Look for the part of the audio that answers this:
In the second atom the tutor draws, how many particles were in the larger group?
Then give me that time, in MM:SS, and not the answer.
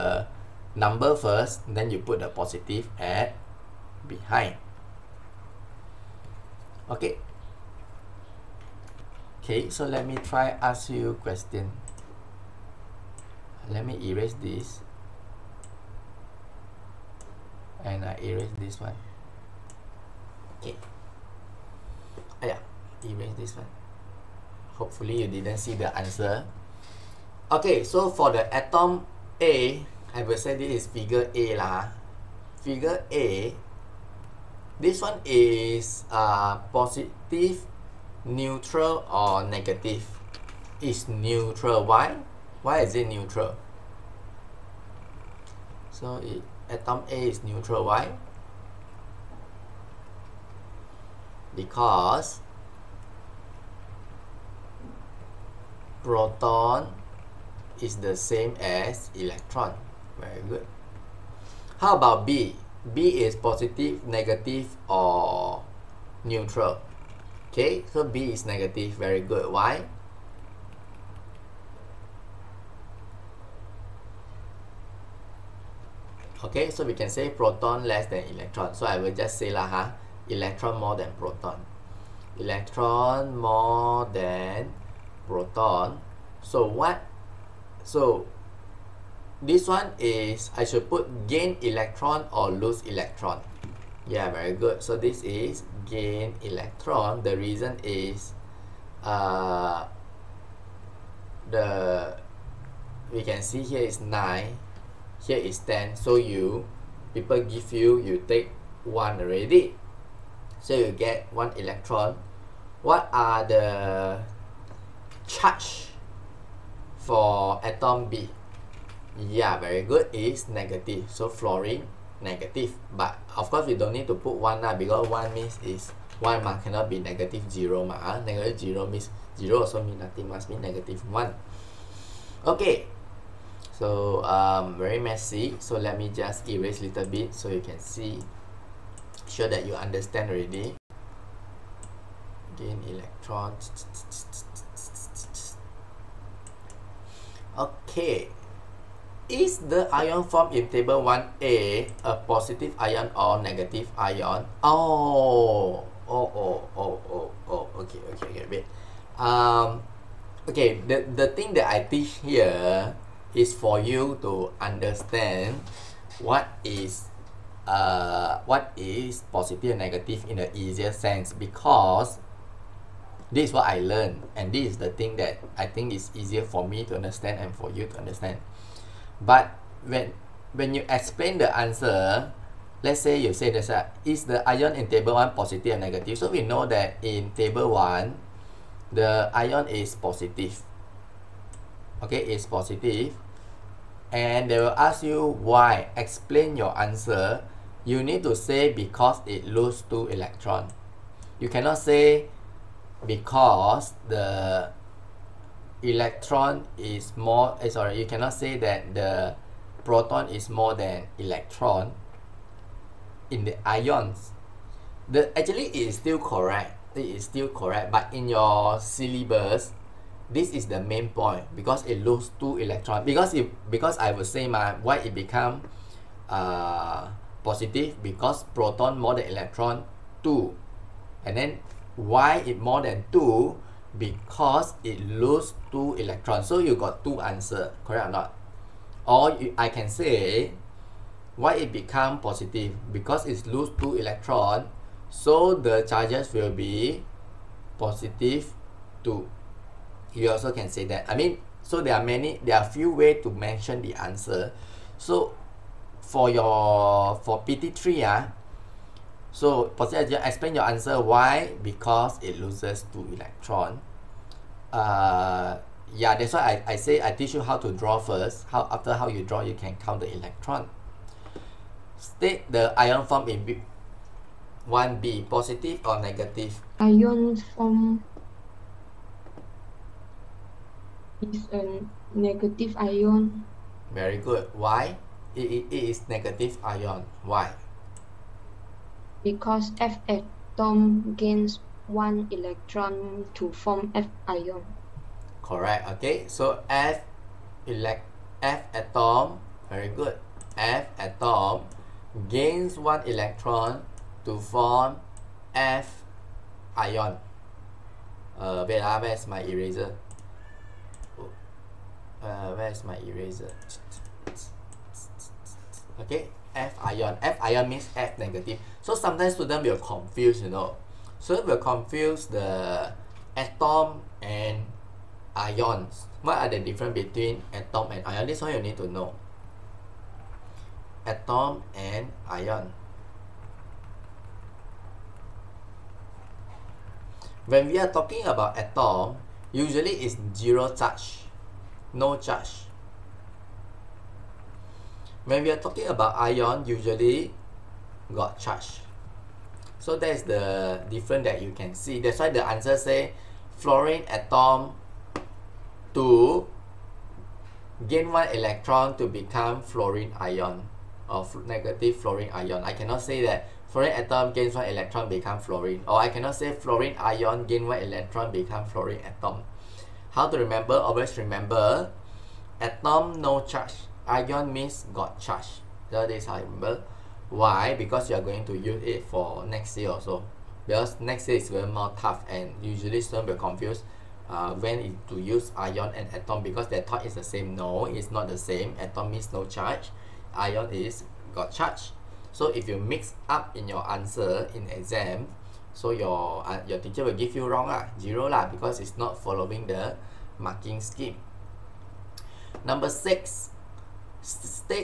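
01:45.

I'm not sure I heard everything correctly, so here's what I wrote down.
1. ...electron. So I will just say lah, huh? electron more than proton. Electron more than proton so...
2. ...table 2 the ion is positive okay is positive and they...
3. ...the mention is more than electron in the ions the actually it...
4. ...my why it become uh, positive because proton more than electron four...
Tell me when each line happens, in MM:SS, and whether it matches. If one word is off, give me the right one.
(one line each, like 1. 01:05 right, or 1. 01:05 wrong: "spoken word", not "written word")
1. 01:18 right
2. 03:07 wrong: "1", not "2"
3. 03:28 wrong: "proton", not "mention"
4. 03:44 wrong: "two", not "four".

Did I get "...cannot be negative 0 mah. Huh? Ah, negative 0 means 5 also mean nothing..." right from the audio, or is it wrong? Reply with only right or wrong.
wrong.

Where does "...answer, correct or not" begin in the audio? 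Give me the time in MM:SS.
03:57.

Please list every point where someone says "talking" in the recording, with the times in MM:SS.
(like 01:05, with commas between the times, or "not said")
05:37, 05:45.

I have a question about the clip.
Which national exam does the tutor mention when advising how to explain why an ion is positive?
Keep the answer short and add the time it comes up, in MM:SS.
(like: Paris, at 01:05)
PT3, at 04:17.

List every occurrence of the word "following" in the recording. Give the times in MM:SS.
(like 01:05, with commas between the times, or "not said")
06:39.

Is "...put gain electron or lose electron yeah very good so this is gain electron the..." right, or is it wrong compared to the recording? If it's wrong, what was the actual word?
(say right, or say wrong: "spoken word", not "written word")
right.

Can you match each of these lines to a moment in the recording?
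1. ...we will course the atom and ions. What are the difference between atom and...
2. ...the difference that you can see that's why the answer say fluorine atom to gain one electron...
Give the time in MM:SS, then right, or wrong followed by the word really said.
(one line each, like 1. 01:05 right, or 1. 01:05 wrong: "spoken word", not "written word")
1. 05:21 wrong: "confuse", not "course"
2. 05:50 right.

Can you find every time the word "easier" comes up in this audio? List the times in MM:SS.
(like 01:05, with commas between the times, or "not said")
02:50, 02:56.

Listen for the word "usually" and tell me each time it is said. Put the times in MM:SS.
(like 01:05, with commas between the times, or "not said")
05:39, 05:46, 06:22.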